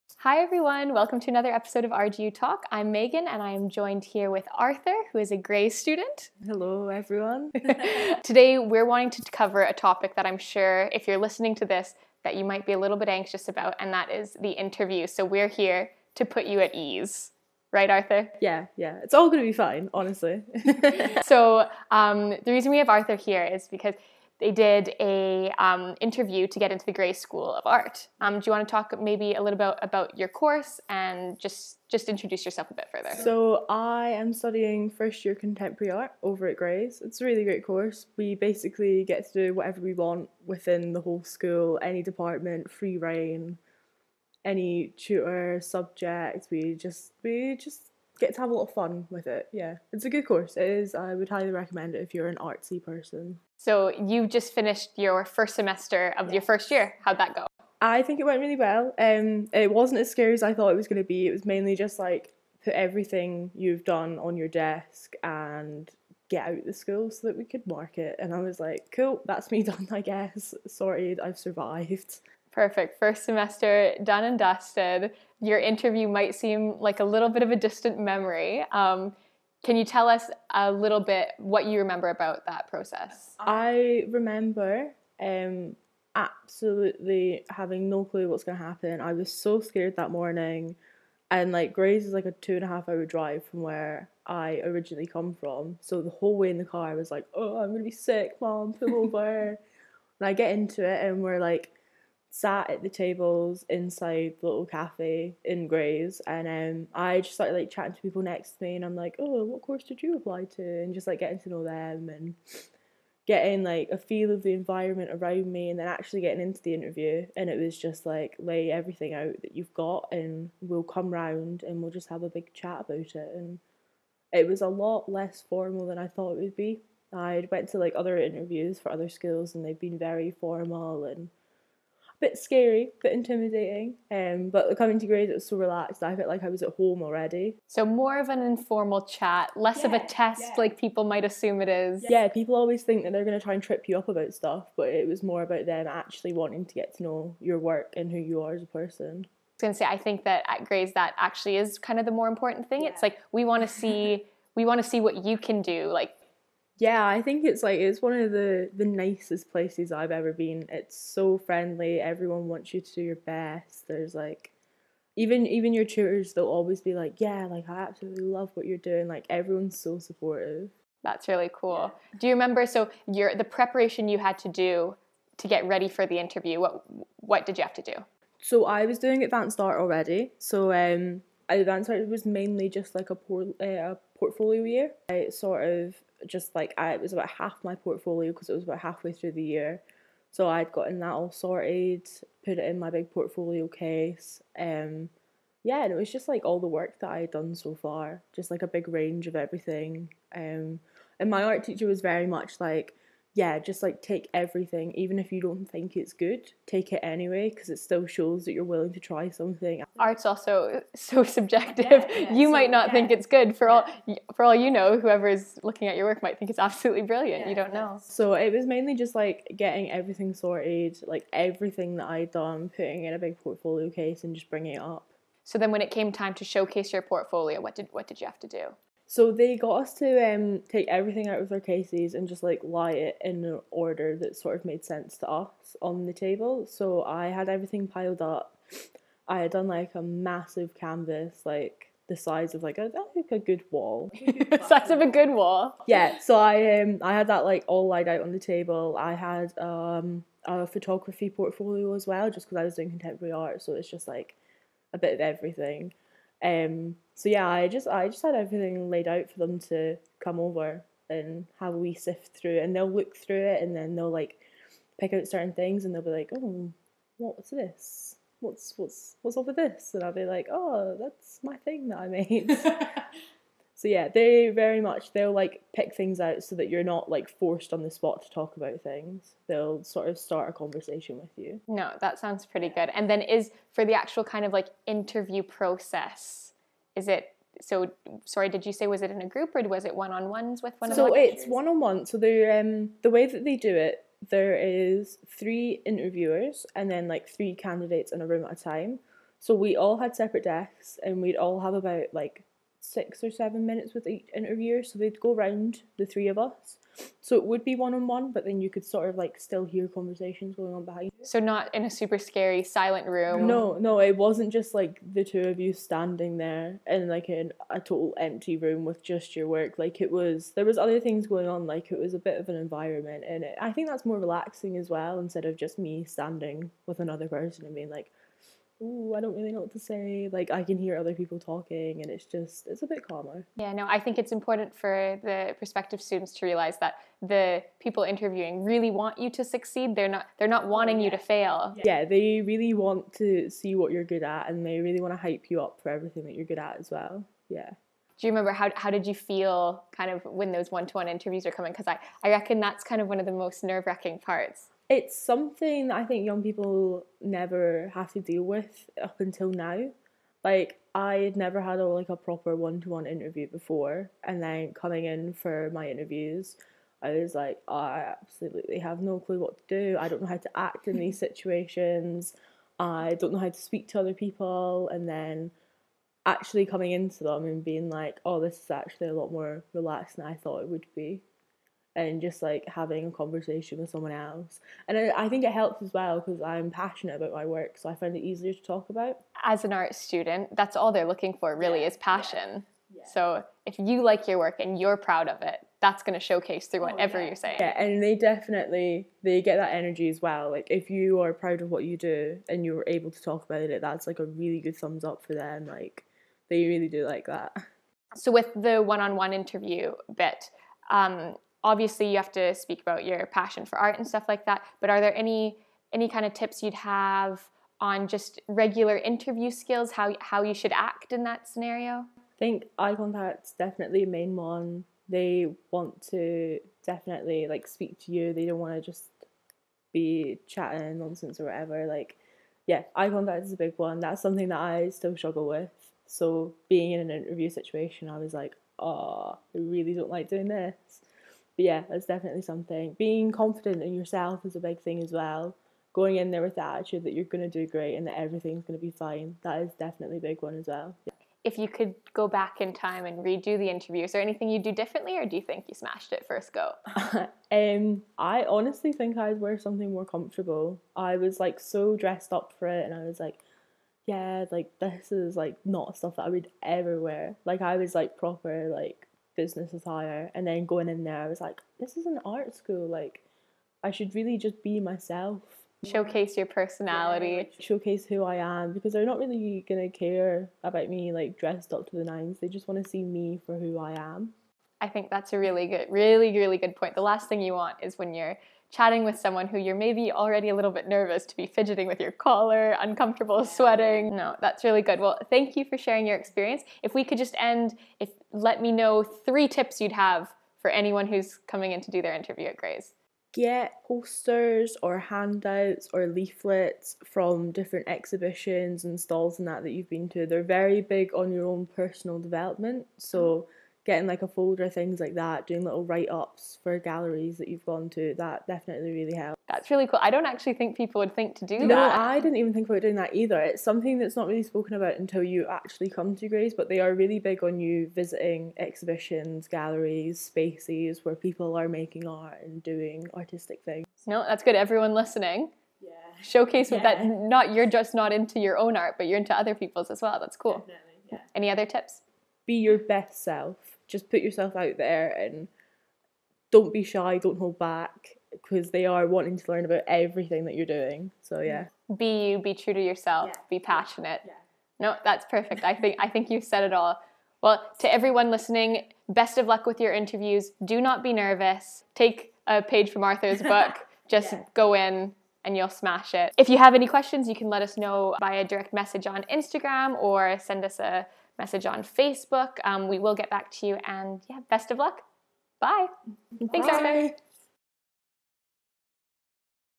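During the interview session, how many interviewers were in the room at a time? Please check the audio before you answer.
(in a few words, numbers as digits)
3.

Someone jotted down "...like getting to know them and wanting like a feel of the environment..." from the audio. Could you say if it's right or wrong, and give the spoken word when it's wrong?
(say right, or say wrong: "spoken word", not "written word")
wrong: "getting", not "wanting".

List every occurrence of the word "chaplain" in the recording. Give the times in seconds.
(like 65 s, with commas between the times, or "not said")
not said.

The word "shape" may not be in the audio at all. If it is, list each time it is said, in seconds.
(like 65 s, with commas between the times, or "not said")
not said.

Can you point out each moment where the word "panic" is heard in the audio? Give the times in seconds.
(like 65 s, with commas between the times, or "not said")
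not said.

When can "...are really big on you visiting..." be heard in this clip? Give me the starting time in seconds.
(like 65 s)
526 s.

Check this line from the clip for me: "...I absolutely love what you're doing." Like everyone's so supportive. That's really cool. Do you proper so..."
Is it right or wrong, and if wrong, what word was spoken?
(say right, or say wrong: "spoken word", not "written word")
wrong: "remember", not "proper".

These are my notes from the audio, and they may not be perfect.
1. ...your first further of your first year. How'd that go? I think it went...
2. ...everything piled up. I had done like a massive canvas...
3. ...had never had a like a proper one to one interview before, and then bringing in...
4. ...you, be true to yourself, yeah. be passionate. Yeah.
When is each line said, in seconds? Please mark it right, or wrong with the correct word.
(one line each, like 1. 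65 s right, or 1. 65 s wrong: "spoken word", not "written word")
1. 54 s wrong: "semester", not "further"
2. 237 s right
3. 361 s wrong: "coming", not "bringing"
4. 552 s right.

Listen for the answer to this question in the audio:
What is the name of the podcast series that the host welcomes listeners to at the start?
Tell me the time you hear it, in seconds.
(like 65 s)
1 s.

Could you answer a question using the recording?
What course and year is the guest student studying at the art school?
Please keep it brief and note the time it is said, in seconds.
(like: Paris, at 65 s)
first year contemporary art, at 34 s.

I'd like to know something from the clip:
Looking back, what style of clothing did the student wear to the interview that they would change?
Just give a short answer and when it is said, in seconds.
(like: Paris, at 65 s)
business attire, at 469 s.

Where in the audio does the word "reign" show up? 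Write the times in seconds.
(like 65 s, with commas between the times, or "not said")
42 s.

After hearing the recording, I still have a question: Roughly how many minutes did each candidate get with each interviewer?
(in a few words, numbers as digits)
6 or 7 minutes.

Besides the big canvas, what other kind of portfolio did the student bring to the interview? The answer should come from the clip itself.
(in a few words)
photography portfolio.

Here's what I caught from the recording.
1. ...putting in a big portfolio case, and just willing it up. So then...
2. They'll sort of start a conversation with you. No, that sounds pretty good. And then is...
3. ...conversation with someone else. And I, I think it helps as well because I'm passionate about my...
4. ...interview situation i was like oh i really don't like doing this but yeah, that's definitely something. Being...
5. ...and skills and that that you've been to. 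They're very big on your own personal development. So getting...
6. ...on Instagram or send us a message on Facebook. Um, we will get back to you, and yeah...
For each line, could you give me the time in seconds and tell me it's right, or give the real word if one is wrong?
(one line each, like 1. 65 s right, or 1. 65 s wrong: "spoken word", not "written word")
1. 222 s wrong: "bringing", not "willing"
2. 279 s right
3. 383 s right
4. 437 s right
5. 508 s wrong: "stalls", not "skills"
6. 569 s right.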